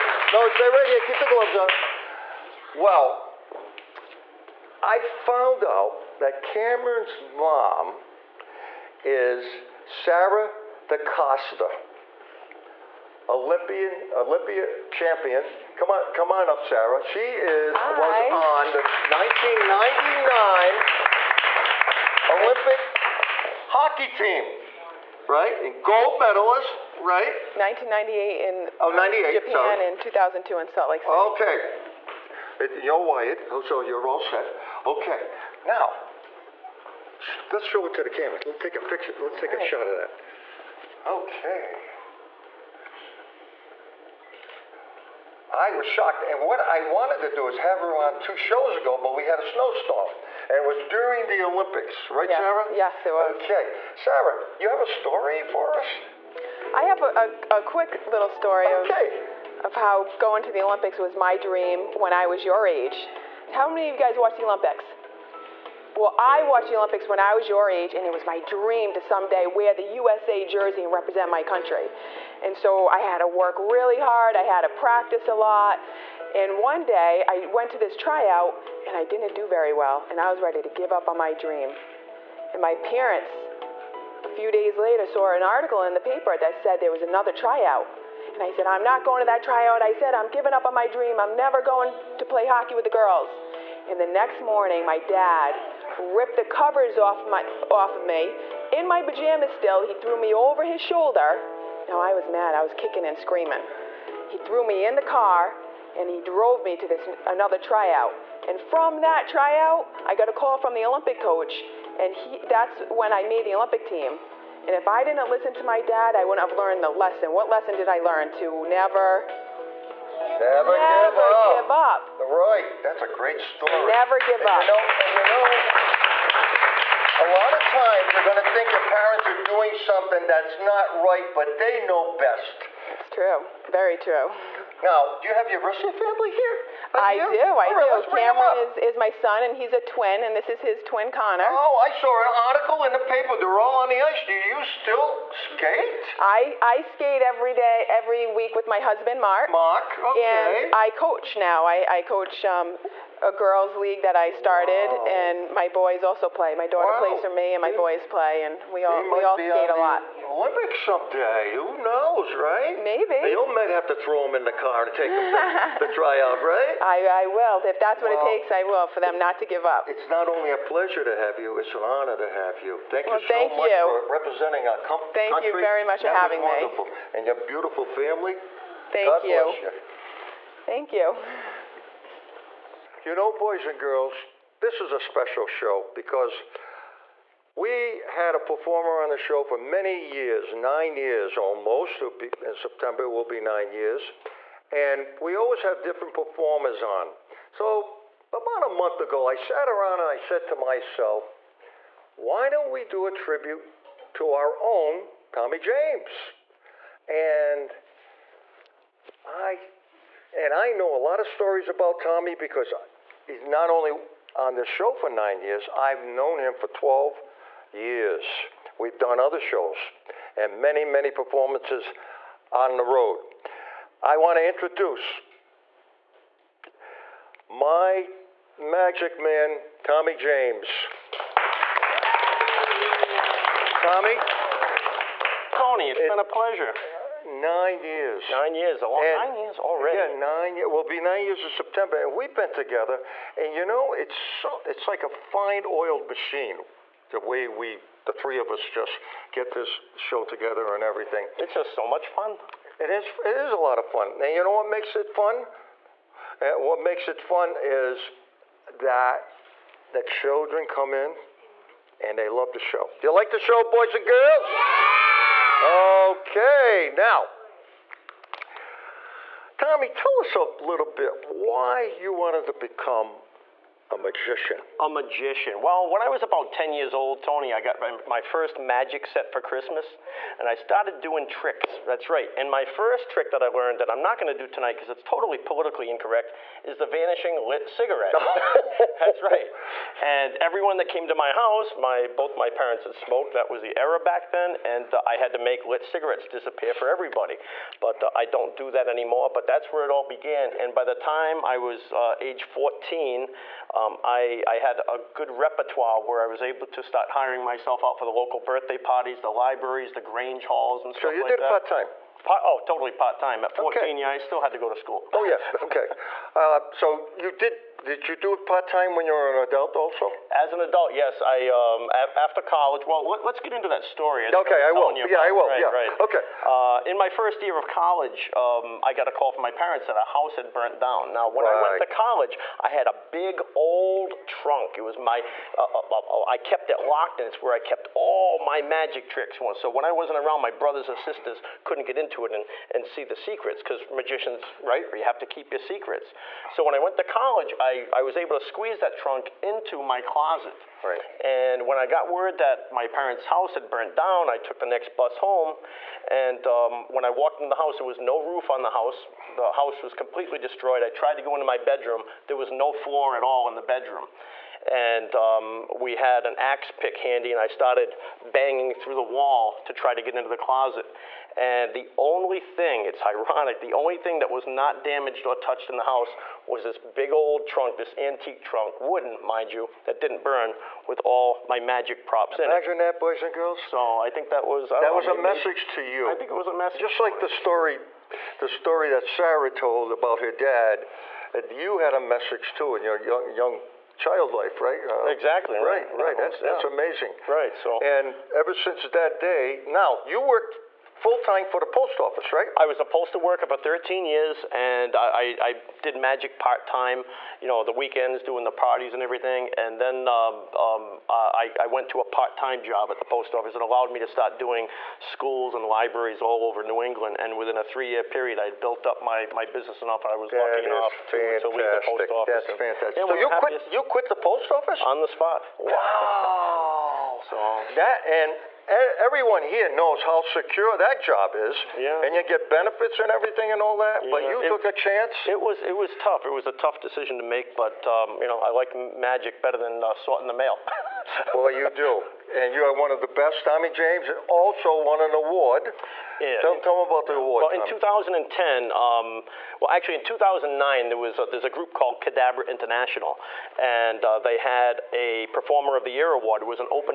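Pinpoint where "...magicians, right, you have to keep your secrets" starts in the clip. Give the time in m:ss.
5:43.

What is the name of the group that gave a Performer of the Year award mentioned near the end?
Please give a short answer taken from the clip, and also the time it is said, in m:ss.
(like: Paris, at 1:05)
Kidabra International, at 7:32.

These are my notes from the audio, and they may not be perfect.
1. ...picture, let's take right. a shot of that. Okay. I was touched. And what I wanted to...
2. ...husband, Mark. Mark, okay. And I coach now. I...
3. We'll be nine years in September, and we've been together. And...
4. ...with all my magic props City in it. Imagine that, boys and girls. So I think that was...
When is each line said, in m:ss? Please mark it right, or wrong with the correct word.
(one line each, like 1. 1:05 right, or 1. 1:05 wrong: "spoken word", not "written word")
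1. 0:38 wrong: "shocked", not "touched"
2. 2:28 right
3. 4:00 right
4. 6:20 wrong: "Imagine", not "City".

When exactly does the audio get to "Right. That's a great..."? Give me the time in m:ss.
2:02.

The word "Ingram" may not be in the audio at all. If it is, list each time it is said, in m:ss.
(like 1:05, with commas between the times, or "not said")
not said.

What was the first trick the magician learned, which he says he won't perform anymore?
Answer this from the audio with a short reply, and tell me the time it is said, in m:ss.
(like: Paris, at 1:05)
vanishing lit cigarette, at 4:46.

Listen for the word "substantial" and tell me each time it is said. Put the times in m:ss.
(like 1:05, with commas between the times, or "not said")
not said.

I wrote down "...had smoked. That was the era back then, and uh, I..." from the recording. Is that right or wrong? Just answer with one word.
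right.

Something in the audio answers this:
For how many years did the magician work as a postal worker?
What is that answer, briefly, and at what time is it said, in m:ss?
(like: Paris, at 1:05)
13, at 6:43.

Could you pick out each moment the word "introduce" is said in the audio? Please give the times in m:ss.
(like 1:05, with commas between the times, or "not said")
3:44.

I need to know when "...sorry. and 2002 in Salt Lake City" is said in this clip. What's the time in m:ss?
0:29.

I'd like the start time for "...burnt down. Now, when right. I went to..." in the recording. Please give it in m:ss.
5:30.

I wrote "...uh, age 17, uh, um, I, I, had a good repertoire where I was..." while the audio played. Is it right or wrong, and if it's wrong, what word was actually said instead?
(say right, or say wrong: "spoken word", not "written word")
wrong: "14", not "17".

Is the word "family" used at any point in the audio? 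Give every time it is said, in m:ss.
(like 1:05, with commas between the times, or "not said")
2:15, 2:57.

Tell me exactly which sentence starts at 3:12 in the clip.
Be, in September will be nine years.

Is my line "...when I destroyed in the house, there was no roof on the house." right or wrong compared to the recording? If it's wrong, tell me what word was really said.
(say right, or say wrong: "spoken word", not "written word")
wrong: "walked", not "destroyed".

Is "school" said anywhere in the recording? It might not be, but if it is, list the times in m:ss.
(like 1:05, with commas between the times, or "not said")
5:14, 6:54.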